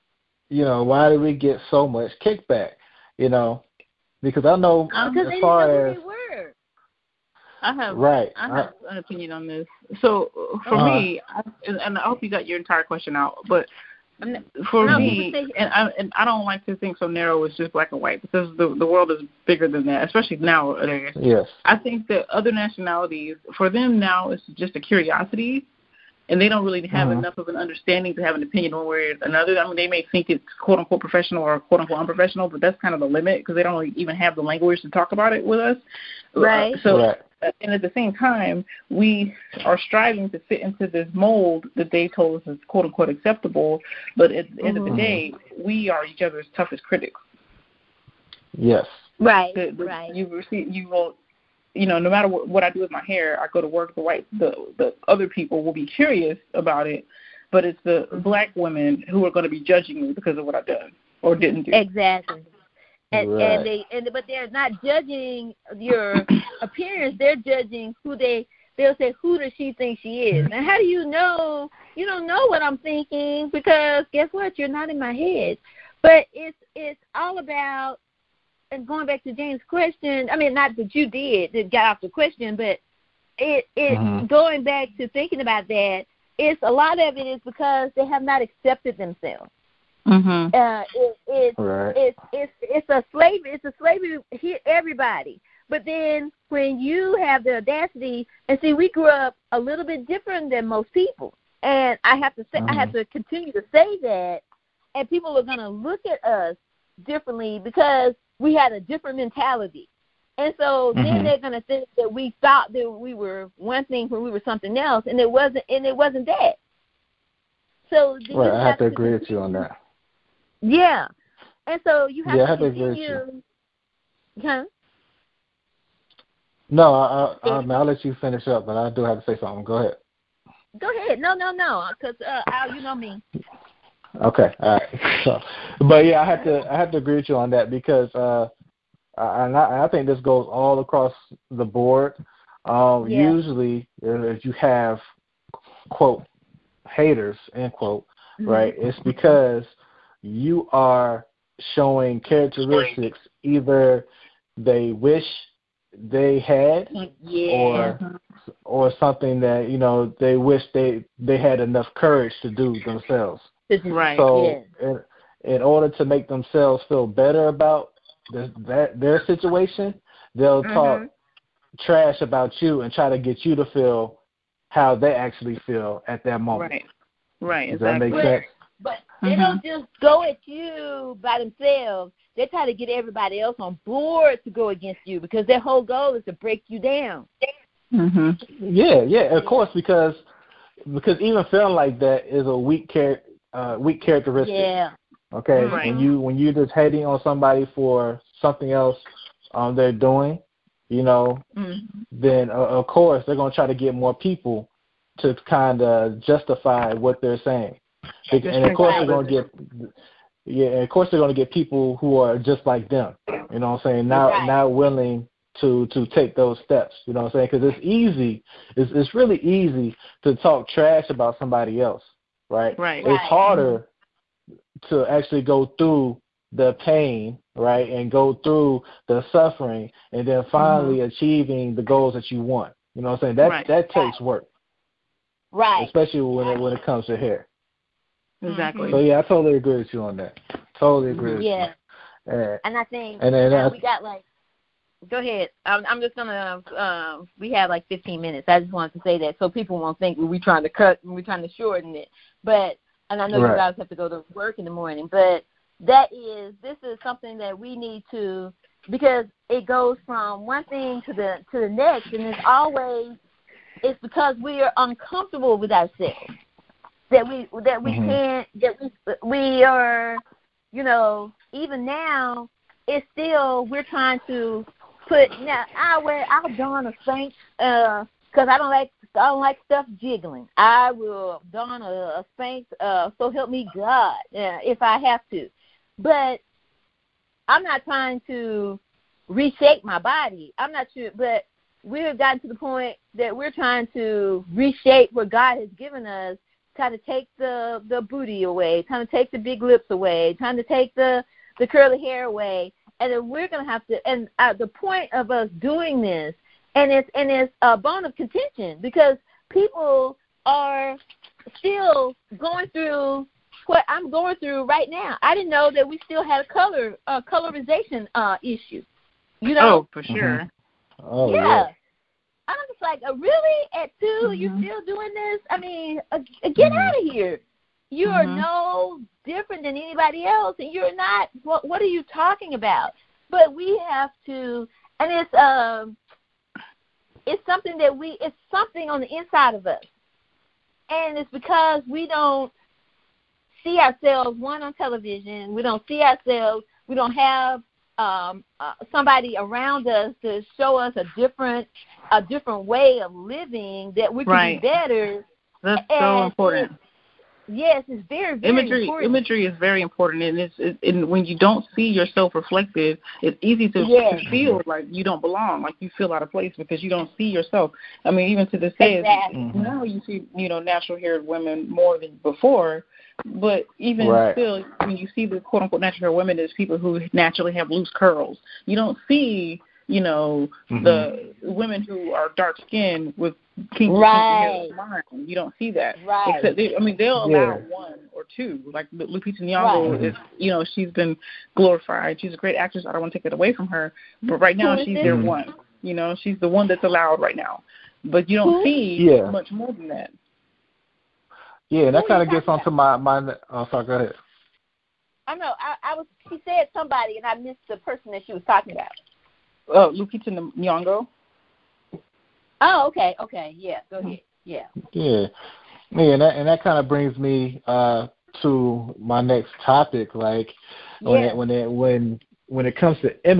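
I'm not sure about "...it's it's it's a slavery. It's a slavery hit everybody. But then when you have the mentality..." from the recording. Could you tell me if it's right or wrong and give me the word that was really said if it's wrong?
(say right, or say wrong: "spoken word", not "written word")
wrong: "audacity", not "mentality".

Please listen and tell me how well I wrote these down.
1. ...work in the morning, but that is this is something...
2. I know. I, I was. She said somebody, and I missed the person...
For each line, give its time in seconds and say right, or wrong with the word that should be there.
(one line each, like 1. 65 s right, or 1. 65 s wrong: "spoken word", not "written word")
1. 254 s right
2. 405 s right.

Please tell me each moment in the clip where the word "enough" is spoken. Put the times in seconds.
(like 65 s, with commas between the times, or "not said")
27 s, 161 s.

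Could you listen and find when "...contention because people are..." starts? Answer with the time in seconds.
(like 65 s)
308 s.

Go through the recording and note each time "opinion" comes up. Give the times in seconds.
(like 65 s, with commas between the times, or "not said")
8 s, 28 s.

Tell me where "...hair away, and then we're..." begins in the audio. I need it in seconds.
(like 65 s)
301 s.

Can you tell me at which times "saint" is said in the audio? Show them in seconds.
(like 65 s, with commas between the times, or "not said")
277 s, 282 s.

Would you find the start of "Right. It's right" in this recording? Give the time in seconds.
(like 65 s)
222 s.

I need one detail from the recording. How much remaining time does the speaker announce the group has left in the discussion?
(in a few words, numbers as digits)
15 minutes.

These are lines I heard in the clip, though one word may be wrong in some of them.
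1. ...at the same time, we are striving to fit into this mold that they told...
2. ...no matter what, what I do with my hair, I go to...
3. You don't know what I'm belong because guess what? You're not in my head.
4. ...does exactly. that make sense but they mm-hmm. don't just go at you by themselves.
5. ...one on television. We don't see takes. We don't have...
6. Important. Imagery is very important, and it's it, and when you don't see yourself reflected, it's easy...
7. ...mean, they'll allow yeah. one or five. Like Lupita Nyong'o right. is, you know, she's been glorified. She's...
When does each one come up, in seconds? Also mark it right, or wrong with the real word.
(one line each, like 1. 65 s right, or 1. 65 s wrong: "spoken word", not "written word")
1. 37 s right
2. 51 s right
3. 71 s wrong: "thinking", not "belong"
4. 177 s right
5. 344 s wrong: "ourselves", not "takes"
6. 358 s right
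7. 386 s wrong: "two", not "five".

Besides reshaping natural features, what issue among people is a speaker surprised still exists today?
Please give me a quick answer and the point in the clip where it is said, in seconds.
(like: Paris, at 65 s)
Colorization, at 317 s.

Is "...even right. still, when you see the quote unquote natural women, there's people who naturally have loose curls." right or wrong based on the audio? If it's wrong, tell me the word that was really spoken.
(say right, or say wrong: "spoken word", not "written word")
right.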